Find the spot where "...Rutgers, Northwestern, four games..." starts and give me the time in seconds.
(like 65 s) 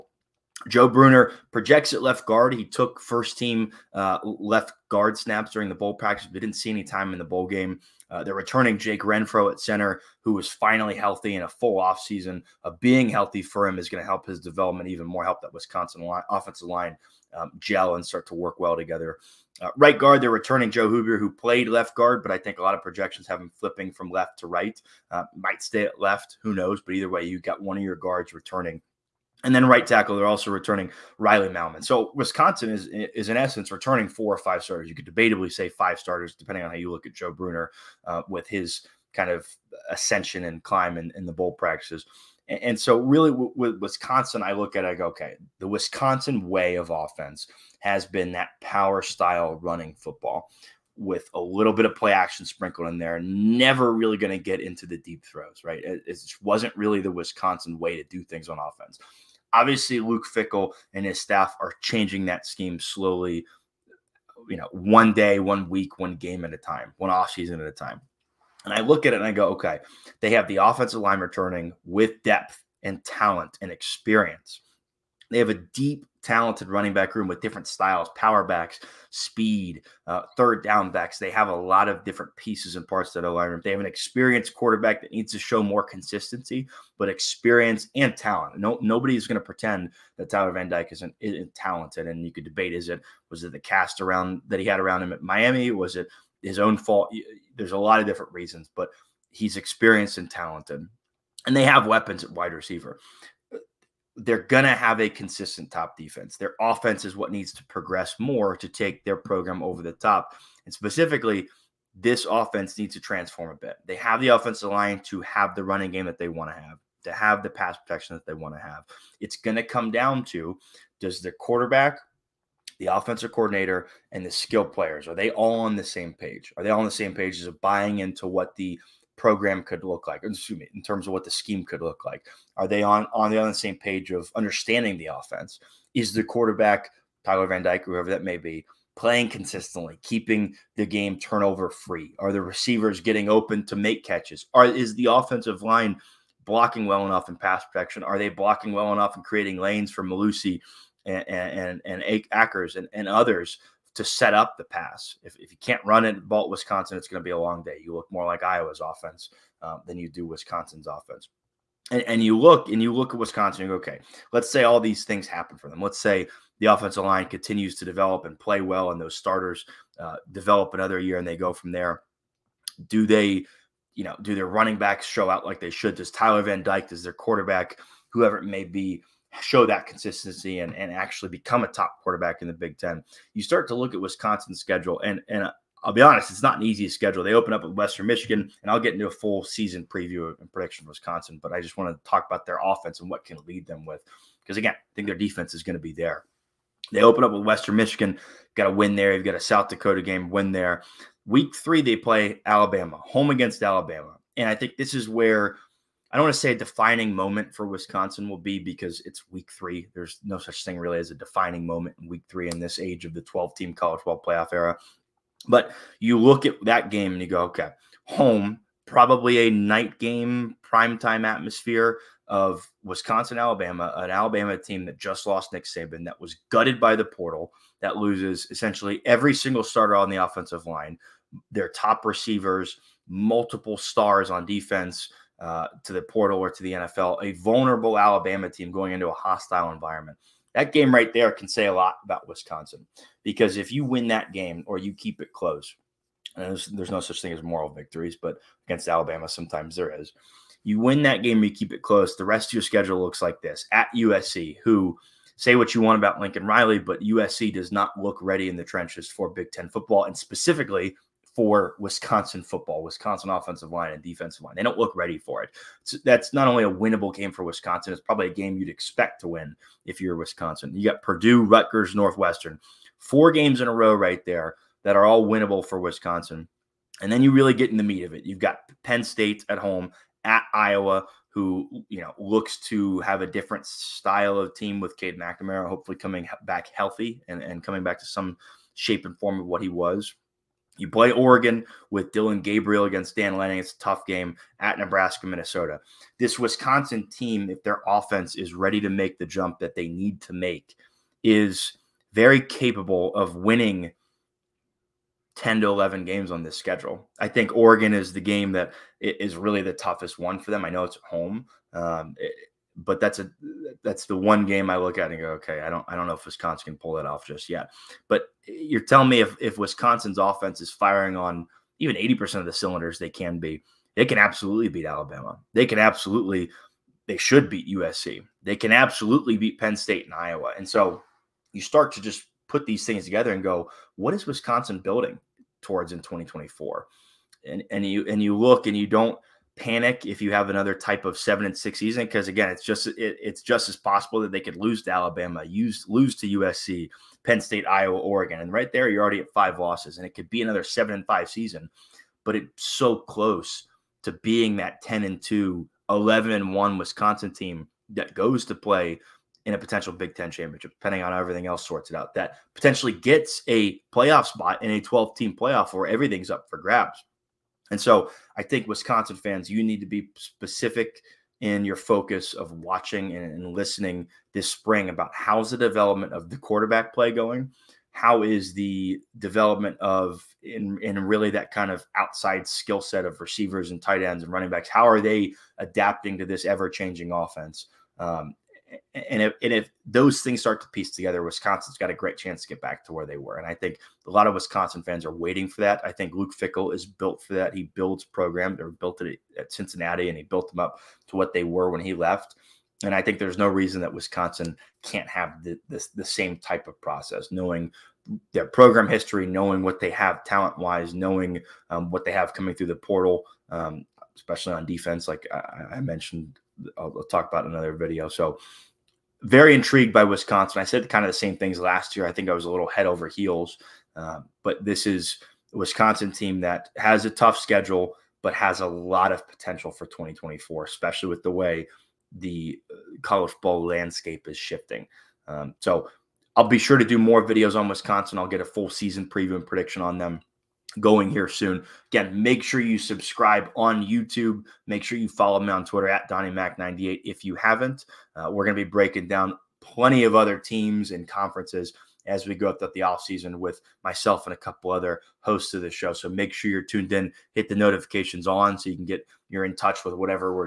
271 s.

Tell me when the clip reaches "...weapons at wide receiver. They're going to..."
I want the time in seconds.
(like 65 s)
101 s.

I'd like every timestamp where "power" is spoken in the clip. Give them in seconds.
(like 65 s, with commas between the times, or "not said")
48 s, 78 s.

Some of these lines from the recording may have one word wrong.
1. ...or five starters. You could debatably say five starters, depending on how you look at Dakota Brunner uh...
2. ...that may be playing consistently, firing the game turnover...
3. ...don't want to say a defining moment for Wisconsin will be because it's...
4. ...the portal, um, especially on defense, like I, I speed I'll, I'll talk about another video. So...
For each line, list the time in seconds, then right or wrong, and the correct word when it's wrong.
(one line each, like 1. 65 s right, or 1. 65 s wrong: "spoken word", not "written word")
1. 34 s wrong: "Joe", not "Dakota"
2. 138 s wrong: "keeping", not "firing"
3. 206 s right
4. 412 s wrong: "mentioned", not "speed".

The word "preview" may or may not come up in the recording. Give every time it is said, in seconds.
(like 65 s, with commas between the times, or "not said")
189 s, 439 s.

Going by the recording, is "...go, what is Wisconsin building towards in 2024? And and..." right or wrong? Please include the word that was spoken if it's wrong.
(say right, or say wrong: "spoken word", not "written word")
right.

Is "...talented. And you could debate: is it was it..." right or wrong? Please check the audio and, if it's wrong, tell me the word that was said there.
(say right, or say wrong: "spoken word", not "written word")
right.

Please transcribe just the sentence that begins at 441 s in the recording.
Again, make sure you subscribe on YouTube.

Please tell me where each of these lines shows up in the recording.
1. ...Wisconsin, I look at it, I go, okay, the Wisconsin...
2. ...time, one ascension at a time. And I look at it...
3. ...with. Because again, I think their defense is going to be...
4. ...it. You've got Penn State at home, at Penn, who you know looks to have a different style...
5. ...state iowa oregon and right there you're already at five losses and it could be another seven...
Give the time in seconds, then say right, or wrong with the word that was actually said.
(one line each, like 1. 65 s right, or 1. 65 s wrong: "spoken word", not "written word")
1. 43 s right
2. 66 s wrong: "offseason", not "ascension"
3. 193 s right
4. 278 s wrong: "Iowa", not "Penn"
5. 347 s right.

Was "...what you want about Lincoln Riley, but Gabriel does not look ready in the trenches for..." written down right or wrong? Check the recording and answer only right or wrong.
wrong.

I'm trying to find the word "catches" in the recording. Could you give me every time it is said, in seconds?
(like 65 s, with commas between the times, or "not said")
144 s.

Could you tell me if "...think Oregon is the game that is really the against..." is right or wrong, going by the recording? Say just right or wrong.
wrong.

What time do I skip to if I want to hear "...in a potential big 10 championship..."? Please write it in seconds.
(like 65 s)
359 s.